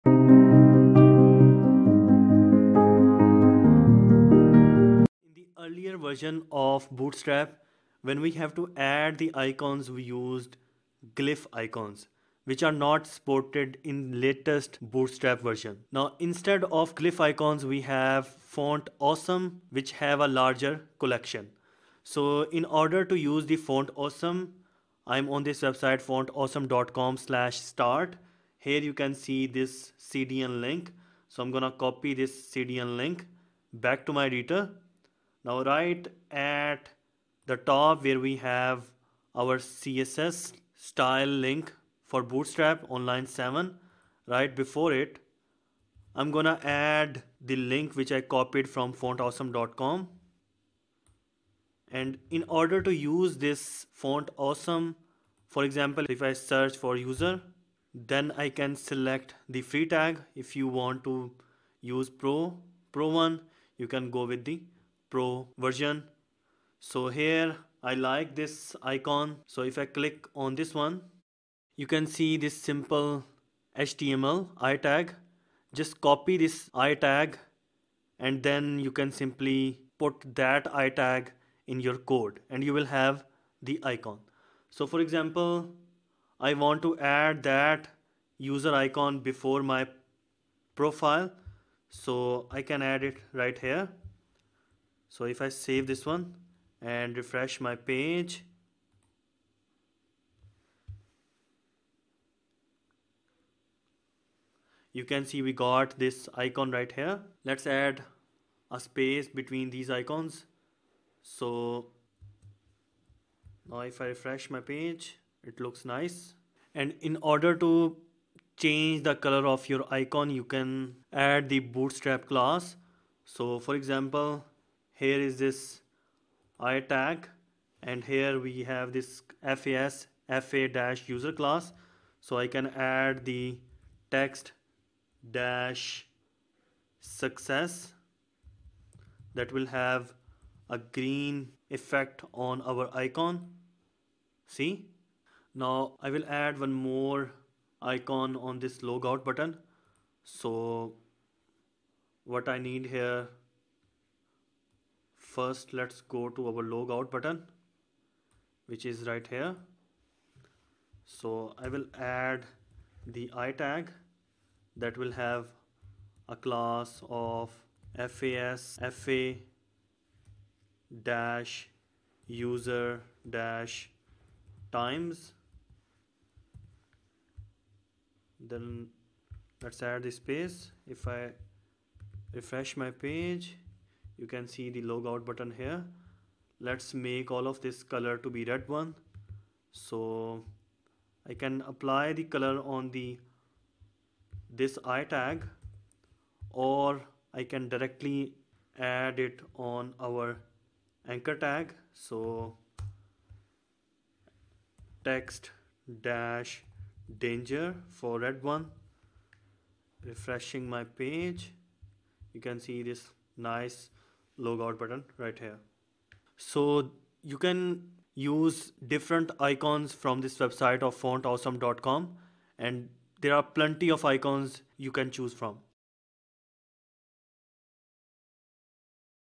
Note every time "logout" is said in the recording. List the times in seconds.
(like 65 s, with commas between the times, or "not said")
148 s, 156 s, 184 s.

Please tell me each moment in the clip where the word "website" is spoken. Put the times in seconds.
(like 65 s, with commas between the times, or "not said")
25 s, 220 s.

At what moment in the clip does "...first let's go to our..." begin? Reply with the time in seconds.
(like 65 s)
155 s.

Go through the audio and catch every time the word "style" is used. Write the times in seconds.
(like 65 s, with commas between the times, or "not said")
40 s.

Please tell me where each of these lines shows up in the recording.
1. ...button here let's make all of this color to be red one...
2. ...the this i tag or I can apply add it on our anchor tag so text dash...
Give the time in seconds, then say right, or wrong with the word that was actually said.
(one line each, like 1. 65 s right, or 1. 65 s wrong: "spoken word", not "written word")
1. 185 s right
2. 192 s wrong: "directly", not "apply".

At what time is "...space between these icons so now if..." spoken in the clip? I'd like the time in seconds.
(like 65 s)
108 s.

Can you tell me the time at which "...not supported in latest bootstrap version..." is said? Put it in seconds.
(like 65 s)
12 s.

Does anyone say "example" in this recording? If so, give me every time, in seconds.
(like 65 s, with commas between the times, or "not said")
55 s, 85 s, 123 s.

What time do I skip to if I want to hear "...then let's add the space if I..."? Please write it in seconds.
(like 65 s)
178 s.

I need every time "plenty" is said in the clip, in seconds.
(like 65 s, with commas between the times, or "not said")
223 s.